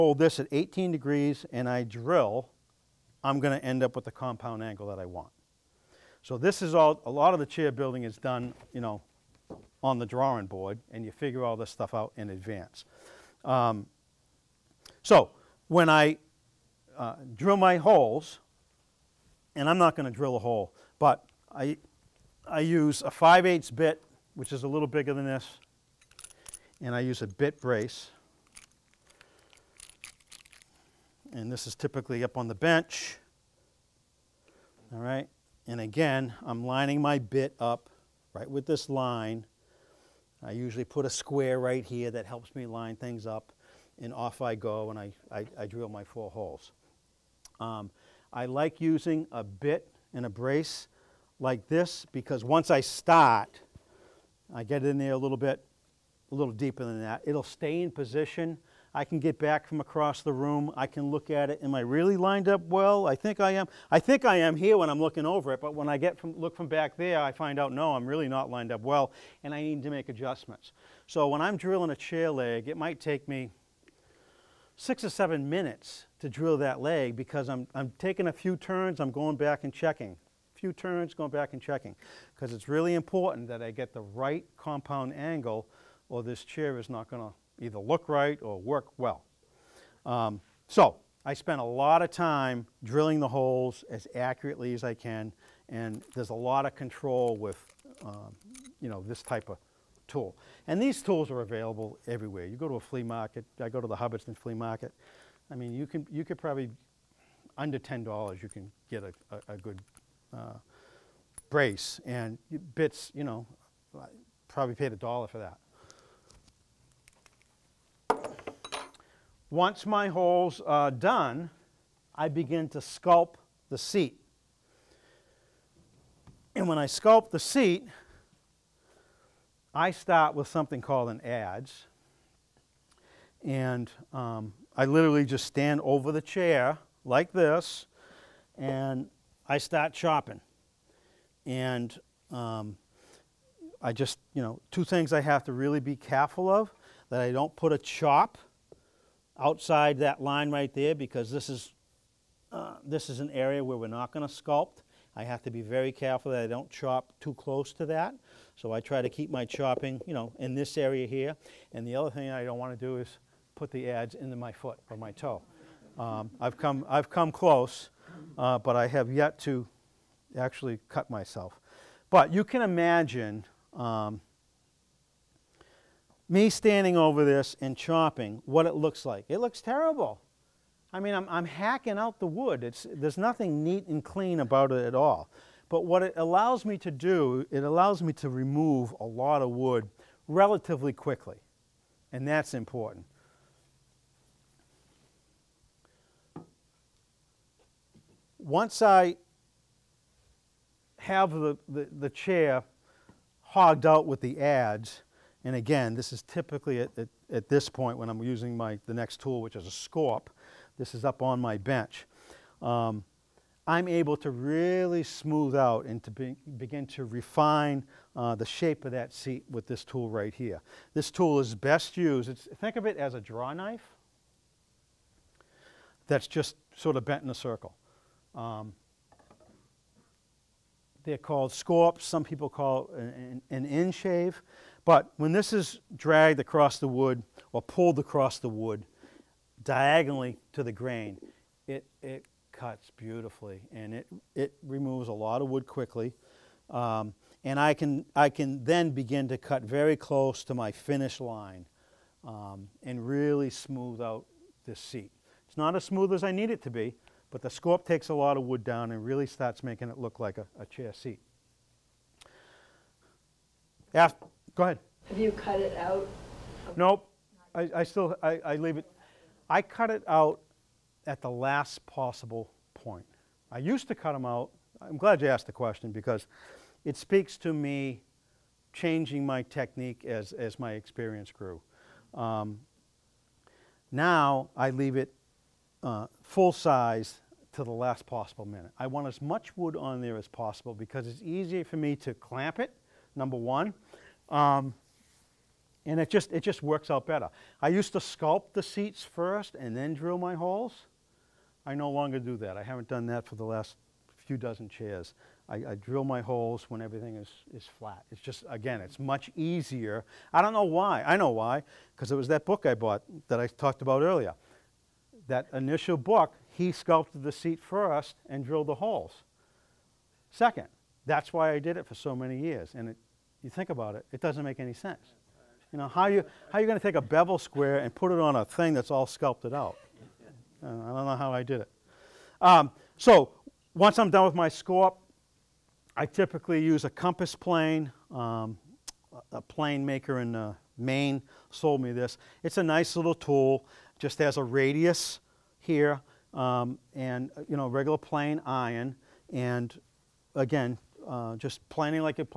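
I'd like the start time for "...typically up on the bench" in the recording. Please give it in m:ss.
0:31.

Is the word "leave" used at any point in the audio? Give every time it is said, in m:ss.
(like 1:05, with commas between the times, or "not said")
4:28, 4:44.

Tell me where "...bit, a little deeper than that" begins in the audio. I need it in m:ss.
0:55.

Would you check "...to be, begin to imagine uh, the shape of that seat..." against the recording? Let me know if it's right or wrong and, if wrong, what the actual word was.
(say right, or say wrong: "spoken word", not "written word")
wrong: "refine", not "imagine".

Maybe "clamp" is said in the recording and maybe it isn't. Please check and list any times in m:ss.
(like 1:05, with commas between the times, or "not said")
4:52.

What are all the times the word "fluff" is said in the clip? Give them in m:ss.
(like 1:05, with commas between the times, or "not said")
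not said.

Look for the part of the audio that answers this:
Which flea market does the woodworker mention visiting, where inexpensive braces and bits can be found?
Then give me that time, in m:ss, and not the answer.
1:43.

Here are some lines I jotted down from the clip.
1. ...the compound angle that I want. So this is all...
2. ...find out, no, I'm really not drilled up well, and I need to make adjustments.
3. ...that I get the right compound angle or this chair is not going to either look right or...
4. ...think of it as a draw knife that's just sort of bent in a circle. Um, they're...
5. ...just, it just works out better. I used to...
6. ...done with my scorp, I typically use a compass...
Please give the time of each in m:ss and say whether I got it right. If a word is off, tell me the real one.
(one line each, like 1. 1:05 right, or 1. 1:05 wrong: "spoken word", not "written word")
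1. 0:04 right
2. 1:07 wrong: "lined", not "drilled"
3. 1:23 right
4. 3:42 right
5. 4:56 right
6. 5:34 right.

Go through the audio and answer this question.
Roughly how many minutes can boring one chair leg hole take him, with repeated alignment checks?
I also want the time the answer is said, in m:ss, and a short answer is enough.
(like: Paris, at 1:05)
6 or 7 minutes, at 1:14.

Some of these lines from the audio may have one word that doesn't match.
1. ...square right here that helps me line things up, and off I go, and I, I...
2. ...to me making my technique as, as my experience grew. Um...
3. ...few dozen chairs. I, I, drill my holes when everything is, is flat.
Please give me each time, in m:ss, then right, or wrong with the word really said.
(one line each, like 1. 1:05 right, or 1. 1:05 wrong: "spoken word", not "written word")
1. 0:41 right
2. 4:37 wrong: "changing", not "making"
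3. 5:04 right.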